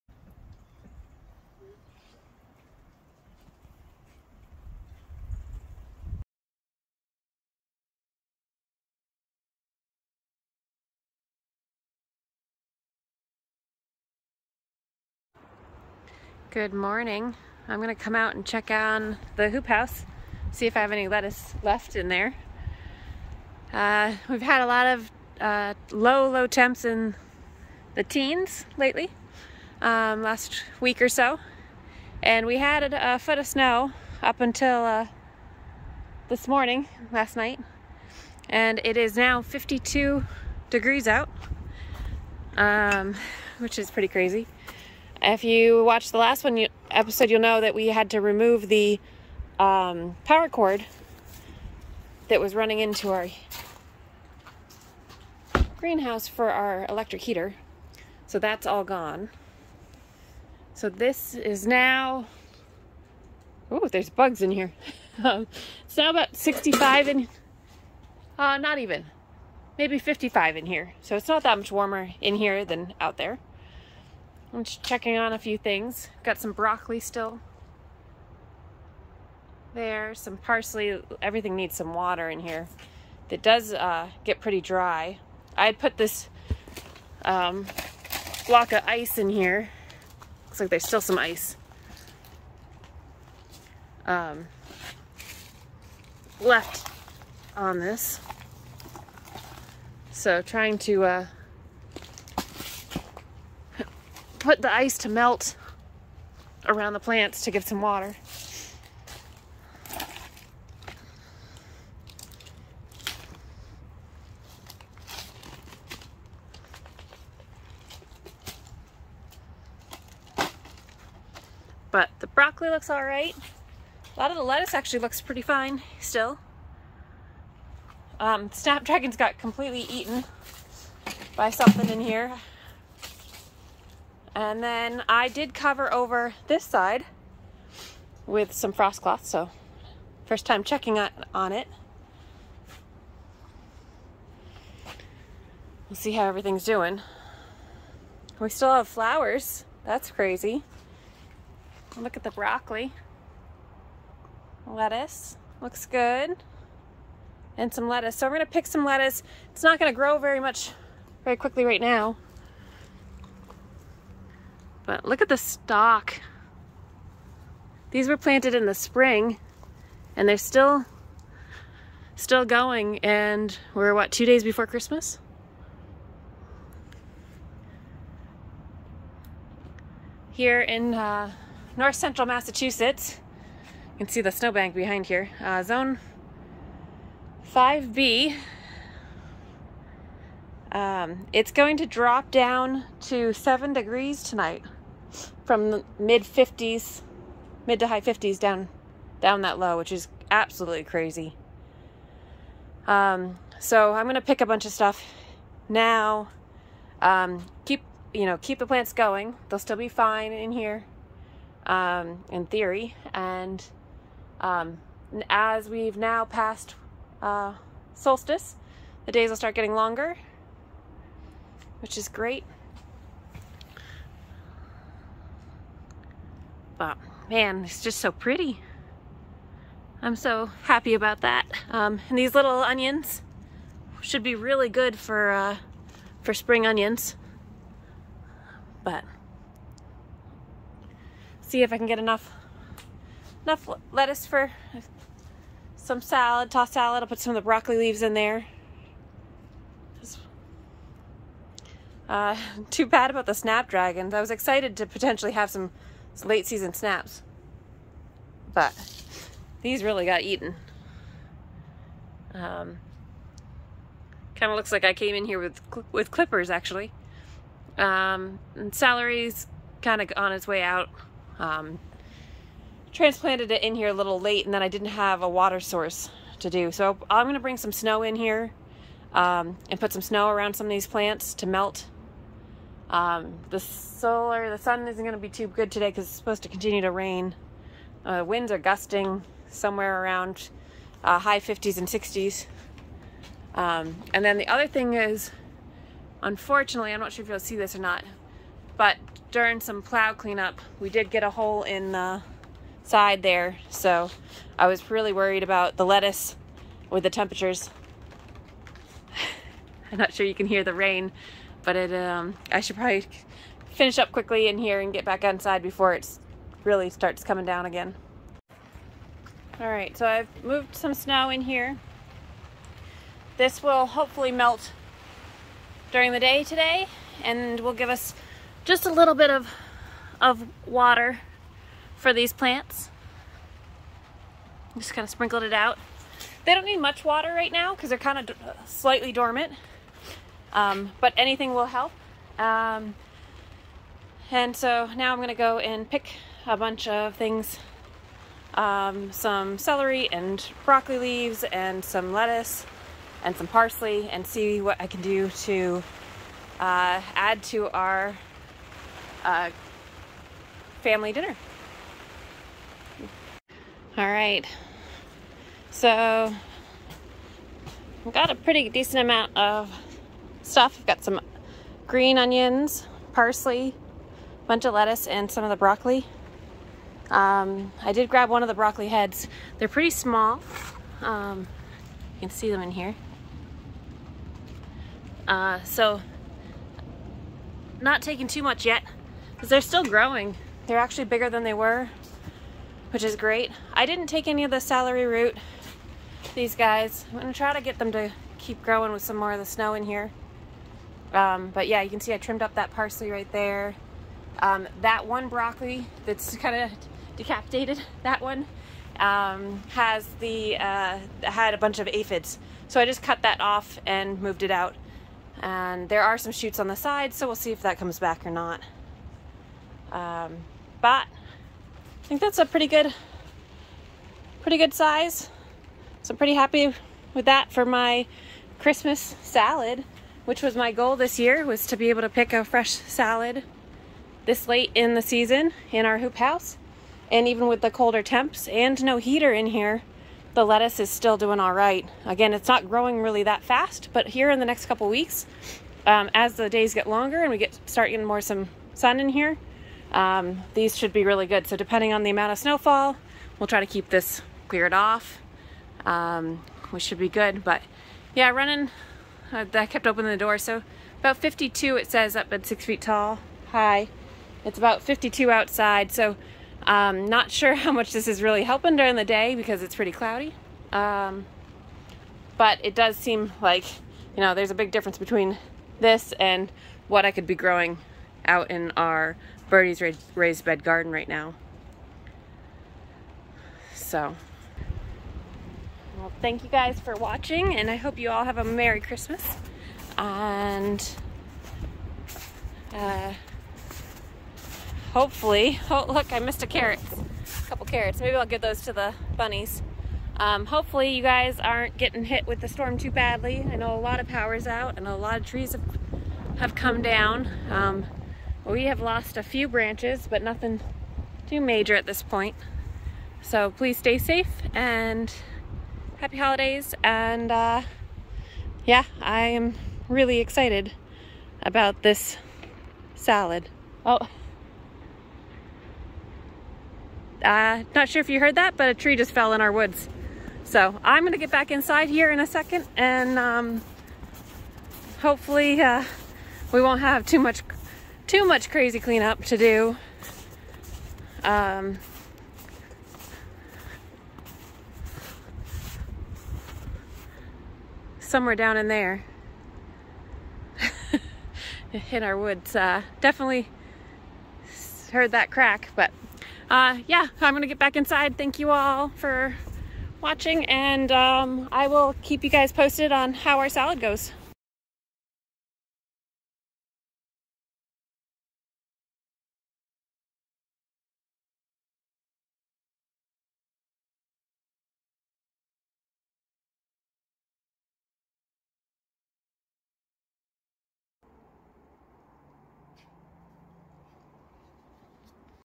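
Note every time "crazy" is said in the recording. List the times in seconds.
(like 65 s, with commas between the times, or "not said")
44 s, 150 s, 200 s, 538 s.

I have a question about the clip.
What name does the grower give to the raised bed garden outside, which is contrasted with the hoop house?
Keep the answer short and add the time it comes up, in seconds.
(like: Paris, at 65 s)
Birdie's, at 479 s.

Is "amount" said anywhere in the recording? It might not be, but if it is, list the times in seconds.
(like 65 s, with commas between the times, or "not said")
369 s, 452 s.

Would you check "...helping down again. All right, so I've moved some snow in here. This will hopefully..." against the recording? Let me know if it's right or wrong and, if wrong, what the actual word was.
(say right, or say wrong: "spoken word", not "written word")
wrong: "coming", not "helping".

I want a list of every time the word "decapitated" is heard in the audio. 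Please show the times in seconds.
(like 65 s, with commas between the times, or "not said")
407 s.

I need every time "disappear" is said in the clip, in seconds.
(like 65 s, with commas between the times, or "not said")
not said.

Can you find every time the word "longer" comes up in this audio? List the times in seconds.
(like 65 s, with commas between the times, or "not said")
219 s, 446 s.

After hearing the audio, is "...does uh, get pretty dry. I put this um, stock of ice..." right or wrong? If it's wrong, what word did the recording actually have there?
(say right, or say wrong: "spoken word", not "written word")
wrong: "block", not "stock".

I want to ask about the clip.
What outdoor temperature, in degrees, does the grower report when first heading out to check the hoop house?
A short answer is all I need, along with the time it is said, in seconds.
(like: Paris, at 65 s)
52, at 39 s.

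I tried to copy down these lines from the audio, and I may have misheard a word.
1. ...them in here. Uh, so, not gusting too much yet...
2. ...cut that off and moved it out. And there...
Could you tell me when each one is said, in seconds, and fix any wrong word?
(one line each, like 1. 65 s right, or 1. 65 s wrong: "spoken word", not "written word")
1. 382 s wrong: "taking", not "gusting"
2. 413 s right.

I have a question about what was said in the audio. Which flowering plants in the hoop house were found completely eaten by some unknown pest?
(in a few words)
snapdragons.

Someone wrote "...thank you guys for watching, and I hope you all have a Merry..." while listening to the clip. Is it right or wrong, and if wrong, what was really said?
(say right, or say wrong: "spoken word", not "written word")
right.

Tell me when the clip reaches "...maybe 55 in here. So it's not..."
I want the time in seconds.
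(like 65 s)
69 s.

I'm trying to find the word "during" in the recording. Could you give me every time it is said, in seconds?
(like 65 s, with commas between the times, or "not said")
299 s, 325 s, 468 s.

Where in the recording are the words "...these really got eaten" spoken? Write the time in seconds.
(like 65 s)
259 s.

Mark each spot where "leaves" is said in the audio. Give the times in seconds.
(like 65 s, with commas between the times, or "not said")
247 s, 350 s.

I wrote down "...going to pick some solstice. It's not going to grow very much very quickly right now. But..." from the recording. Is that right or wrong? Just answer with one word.
wrong.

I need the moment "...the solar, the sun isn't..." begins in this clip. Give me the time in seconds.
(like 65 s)
283 s.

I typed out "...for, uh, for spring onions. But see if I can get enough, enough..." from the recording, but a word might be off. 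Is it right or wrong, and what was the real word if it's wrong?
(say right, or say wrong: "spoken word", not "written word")
right.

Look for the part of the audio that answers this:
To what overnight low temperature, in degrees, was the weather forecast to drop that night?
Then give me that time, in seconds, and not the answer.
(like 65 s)
193 s.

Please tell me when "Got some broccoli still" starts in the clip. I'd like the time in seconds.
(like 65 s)
76 s.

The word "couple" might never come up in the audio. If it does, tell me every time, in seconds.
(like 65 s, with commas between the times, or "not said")
444 s, 497 s.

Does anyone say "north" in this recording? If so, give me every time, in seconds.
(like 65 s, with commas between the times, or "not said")
181 s.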